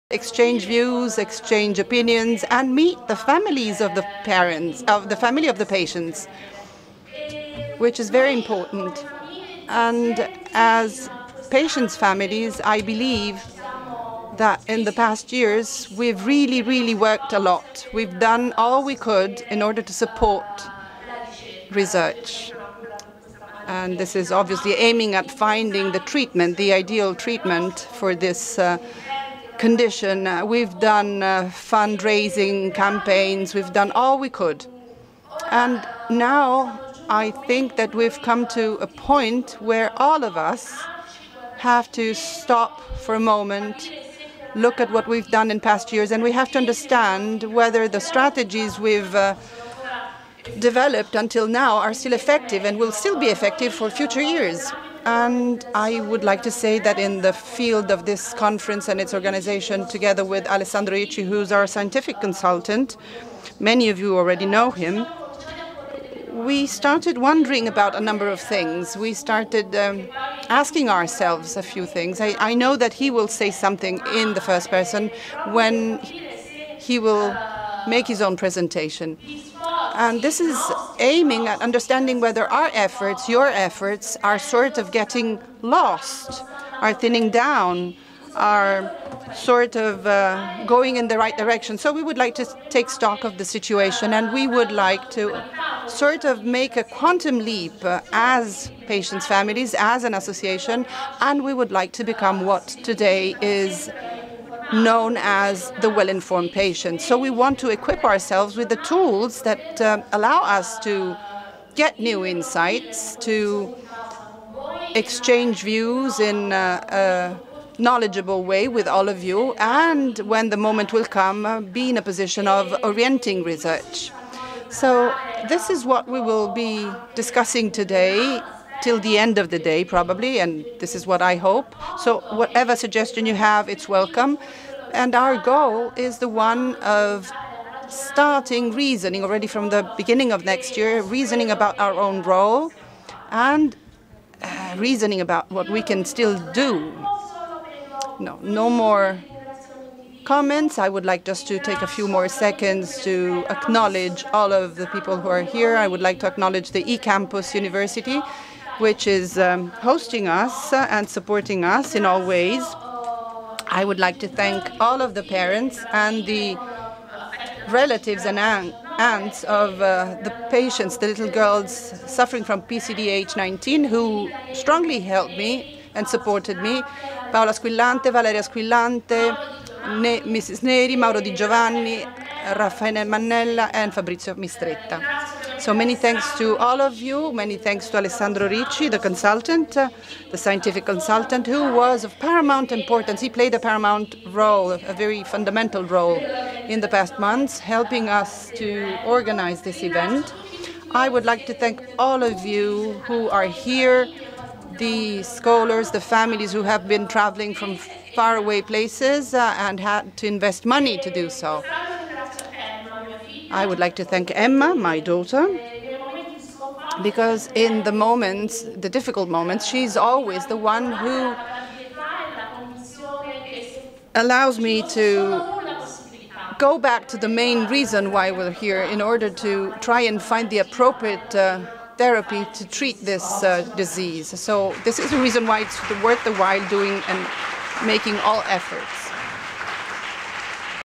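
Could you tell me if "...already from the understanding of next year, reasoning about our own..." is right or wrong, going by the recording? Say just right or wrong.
wrong.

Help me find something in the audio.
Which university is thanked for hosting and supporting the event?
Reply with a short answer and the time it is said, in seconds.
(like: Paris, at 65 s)
eCampus University, at 156 s.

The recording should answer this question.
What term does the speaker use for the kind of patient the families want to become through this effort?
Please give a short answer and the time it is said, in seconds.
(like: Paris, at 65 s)
well informed patient, at 105 s.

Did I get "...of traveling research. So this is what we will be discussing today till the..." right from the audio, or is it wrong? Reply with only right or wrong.
wrong.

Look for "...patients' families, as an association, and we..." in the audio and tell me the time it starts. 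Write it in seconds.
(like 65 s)
98 s.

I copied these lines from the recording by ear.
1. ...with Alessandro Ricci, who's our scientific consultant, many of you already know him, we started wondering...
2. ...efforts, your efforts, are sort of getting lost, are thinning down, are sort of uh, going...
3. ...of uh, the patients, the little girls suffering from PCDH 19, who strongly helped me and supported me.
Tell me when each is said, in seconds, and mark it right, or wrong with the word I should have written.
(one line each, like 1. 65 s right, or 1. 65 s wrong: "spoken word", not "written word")
1. 60 s right
2. 82 s right
3. 169 s right.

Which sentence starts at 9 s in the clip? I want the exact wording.
And as patients' families, I believe that in the past years, we've really, really worked a lot.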